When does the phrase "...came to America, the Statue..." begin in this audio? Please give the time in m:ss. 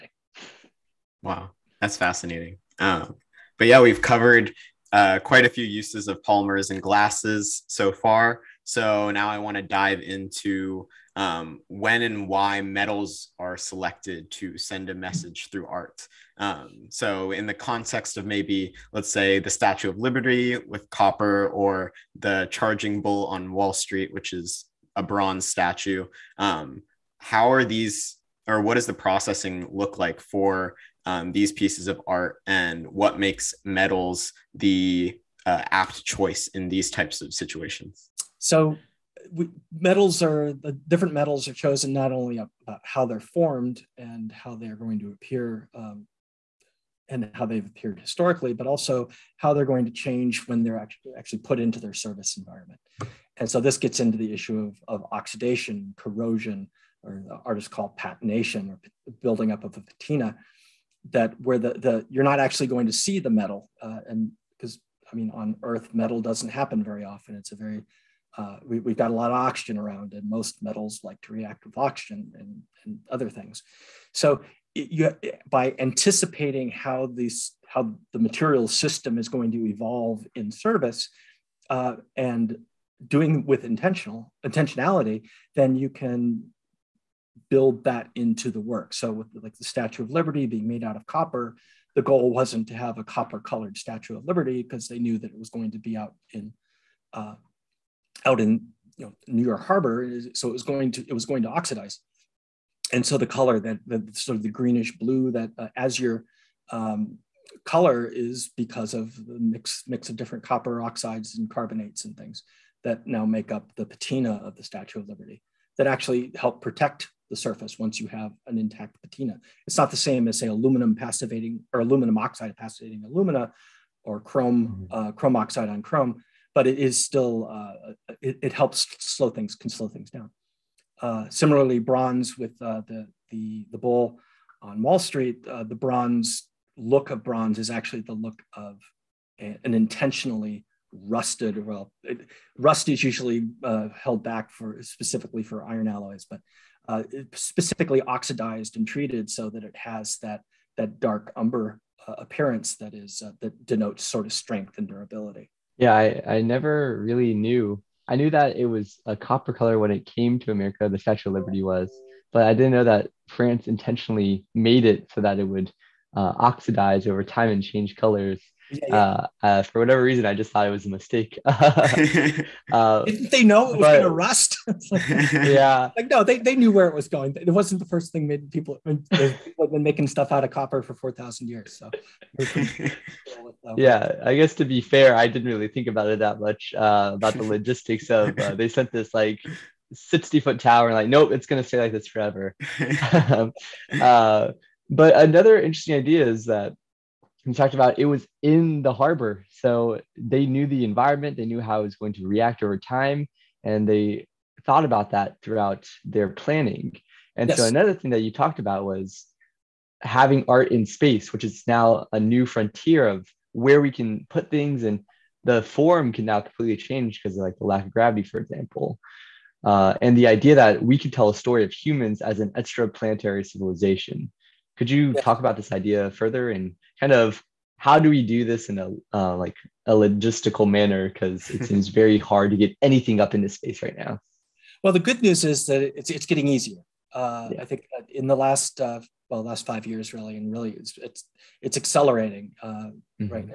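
2:40.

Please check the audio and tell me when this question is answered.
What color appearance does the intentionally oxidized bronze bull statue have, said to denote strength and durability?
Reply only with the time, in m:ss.
2:31.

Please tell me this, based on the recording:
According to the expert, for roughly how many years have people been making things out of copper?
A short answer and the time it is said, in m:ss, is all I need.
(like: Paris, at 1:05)
4,000 years, at 3:00.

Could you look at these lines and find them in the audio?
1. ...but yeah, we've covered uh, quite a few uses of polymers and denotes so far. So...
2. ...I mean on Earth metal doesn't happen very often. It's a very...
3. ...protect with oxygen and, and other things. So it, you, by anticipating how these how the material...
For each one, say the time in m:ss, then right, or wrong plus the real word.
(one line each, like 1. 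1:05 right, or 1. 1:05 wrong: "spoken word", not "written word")
1. 0:03 wrong: "glasses", not "denotes"
2. 1:05 right
3. 1:11 wrong: "react", not "protect".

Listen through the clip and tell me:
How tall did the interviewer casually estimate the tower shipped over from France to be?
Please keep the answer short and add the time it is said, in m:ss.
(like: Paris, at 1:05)
60 foot, at 3:09.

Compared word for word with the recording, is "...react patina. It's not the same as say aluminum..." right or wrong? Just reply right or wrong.
wrong.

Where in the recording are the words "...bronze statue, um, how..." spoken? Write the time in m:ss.
0:25.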